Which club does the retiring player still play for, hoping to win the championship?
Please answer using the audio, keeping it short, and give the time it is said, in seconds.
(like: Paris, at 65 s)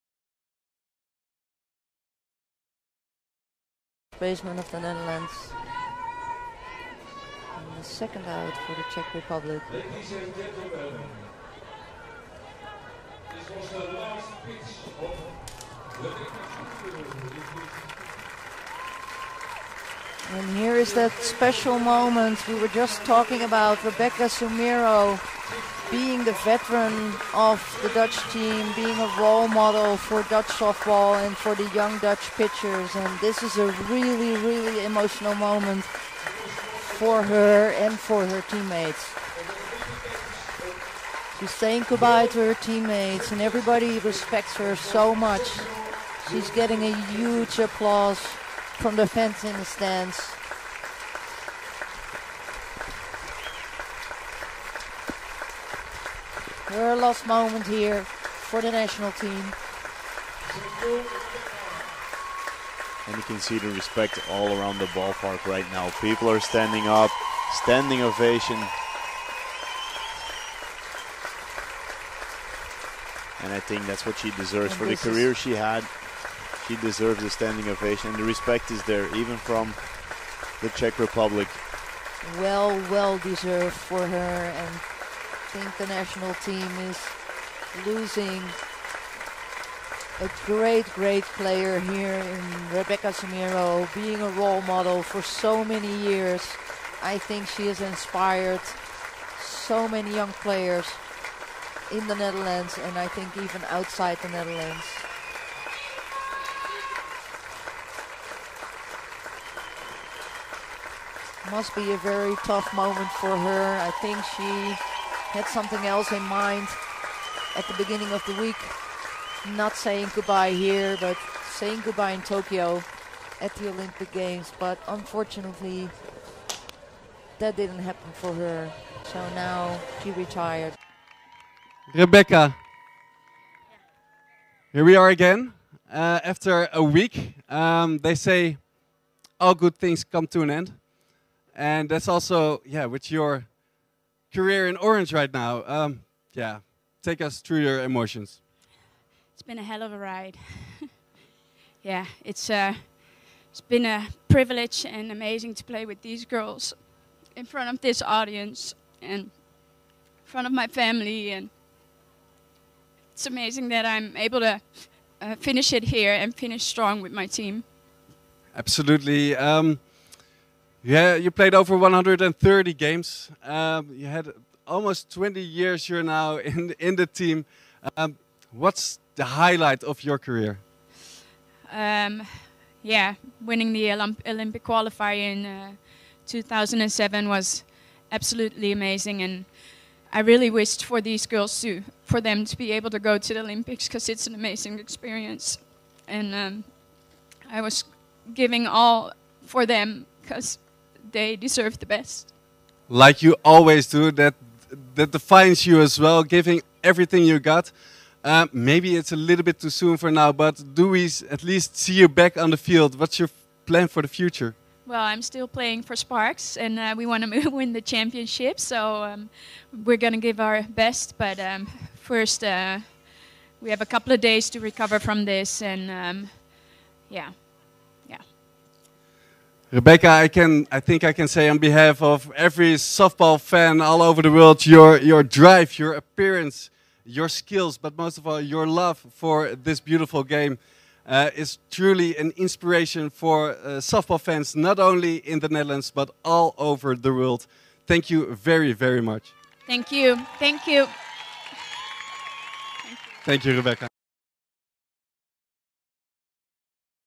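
Sparks, at 215 s.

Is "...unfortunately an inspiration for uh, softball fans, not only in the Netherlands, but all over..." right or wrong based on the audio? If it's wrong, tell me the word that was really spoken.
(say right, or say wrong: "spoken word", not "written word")
wrong: "truly", not "unfortunately".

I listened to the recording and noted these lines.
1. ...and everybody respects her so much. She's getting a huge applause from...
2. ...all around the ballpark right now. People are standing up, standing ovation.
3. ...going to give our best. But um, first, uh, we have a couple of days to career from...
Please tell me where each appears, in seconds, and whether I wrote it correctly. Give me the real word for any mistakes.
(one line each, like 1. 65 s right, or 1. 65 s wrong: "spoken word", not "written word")
1. 43 s right
2. 64 s right
3. 219 s wrong: "recover", not "career".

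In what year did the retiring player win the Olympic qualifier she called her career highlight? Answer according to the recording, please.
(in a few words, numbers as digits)
2007.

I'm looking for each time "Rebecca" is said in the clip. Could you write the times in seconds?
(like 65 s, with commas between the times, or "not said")
23 s, 92 s, 131 s, 229 s, 253 s.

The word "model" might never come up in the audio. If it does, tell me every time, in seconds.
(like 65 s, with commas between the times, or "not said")
29 s, 94 s.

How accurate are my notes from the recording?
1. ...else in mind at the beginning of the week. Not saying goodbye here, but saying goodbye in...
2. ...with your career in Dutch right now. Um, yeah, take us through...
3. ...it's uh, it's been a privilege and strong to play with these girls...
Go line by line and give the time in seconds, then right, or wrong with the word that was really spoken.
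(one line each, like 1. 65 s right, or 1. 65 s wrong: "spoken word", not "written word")
1. 115 s right
2. 142 s wrong: "Orange", not "Dutch"
3. 152 s wrong: "amazing", not "strong".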